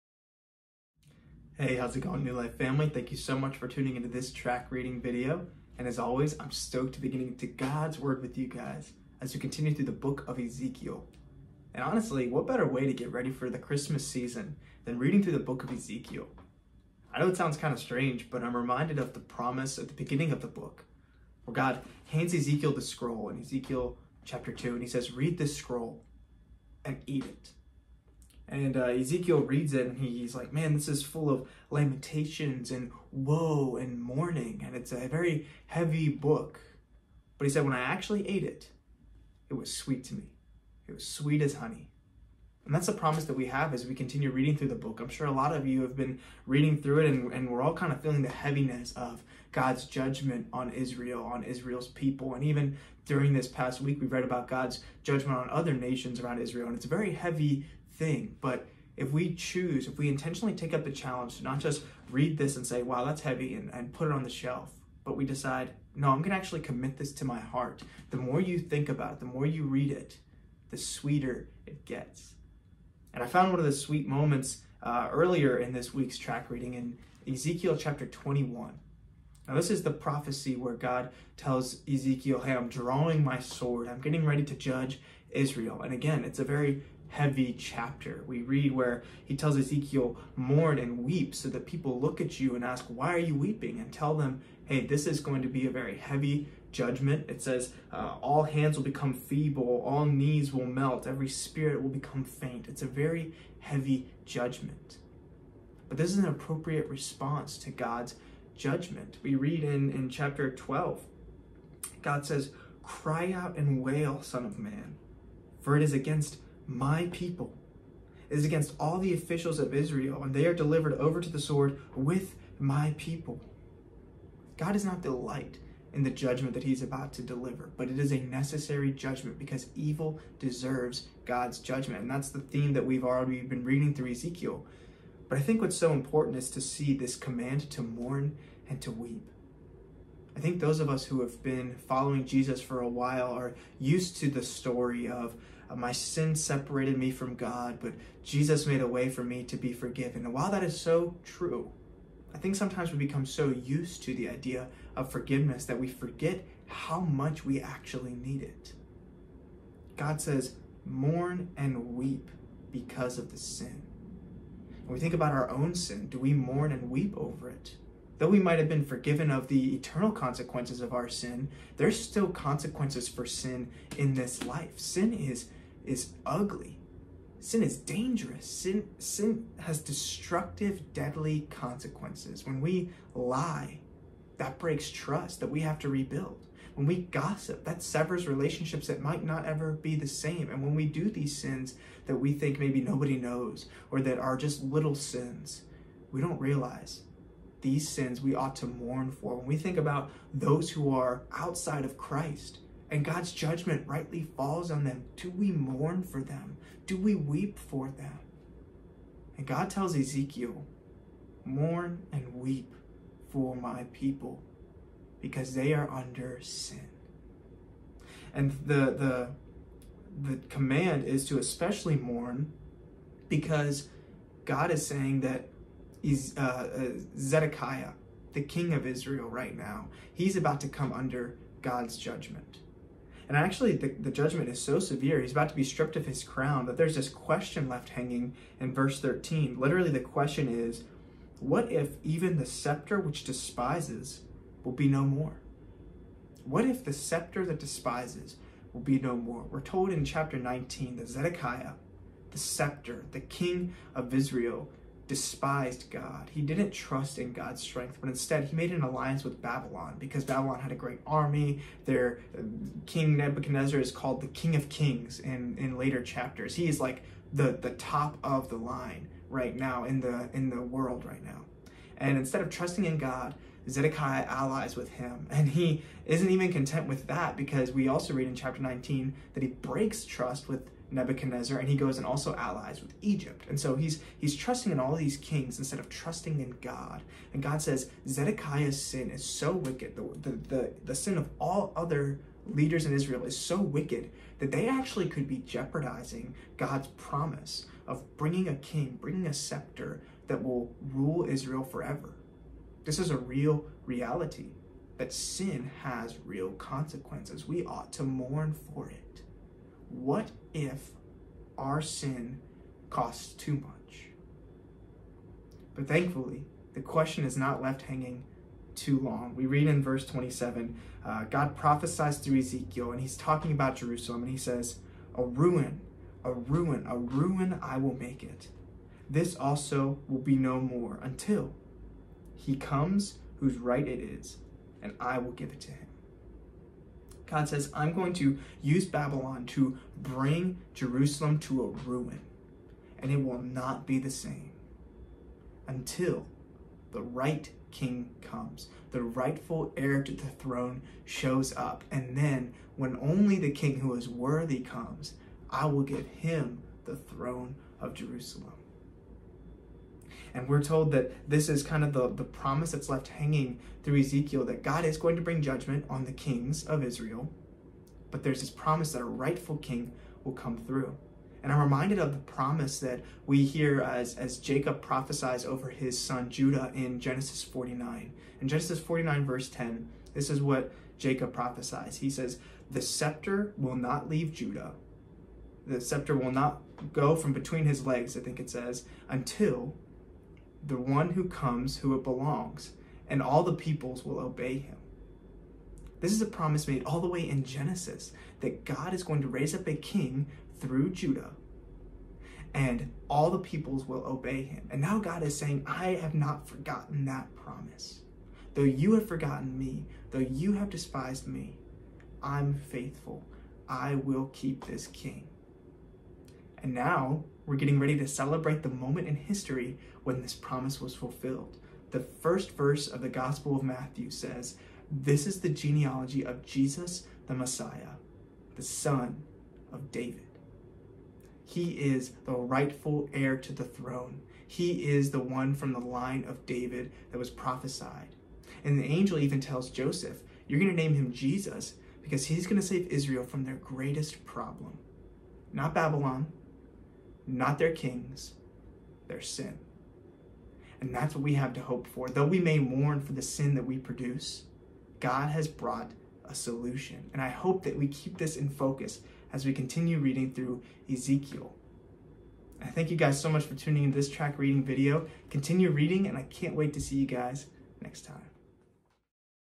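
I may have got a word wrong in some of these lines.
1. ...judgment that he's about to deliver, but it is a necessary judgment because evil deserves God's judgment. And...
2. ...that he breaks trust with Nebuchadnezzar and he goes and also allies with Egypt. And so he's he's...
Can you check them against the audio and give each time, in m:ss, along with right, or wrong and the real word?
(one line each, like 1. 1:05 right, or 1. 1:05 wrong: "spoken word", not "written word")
1. 2:06 right
2. 4:39 right.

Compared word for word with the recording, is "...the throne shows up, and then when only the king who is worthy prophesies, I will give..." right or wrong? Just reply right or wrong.
wrong.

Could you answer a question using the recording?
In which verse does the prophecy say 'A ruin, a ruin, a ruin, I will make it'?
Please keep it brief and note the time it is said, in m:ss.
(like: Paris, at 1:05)
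Verse 27, at 5:19.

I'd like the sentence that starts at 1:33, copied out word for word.
And tell them, Hey, this is going to be a very heavy judgment.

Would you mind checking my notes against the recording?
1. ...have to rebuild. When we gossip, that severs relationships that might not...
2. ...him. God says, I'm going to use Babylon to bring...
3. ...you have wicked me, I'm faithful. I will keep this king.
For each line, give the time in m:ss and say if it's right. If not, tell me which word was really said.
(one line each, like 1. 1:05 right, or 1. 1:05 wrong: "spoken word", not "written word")
1. 3:05 right
2. 5:35 right
3. 6:50 wrong: "despised", not "wicked".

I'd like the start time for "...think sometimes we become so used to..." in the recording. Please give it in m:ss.
2:32.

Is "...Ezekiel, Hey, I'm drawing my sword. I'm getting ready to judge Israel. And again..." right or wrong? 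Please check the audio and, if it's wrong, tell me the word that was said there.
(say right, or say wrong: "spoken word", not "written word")
right.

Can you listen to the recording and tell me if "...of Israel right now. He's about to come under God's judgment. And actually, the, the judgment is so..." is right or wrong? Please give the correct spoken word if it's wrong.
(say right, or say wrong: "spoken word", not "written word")
right.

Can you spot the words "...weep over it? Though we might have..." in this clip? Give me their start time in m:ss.
2:46.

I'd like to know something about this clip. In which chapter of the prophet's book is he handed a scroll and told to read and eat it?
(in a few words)
Chapter 2.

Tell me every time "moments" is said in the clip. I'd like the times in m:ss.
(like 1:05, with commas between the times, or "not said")
1:14, 6:58.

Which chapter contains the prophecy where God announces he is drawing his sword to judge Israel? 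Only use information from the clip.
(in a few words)
Chapter 21.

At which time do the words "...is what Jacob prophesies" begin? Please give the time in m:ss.
6:20.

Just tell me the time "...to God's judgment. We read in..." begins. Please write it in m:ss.
1:47.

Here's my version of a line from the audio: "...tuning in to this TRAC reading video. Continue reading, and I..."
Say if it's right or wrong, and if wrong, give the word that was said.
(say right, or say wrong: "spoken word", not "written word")
right.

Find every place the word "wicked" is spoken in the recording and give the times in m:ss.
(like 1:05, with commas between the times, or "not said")
4:49, 4:53.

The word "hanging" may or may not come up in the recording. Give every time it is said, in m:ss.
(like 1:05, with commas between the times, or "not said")
3:57, 5:17, 6:03.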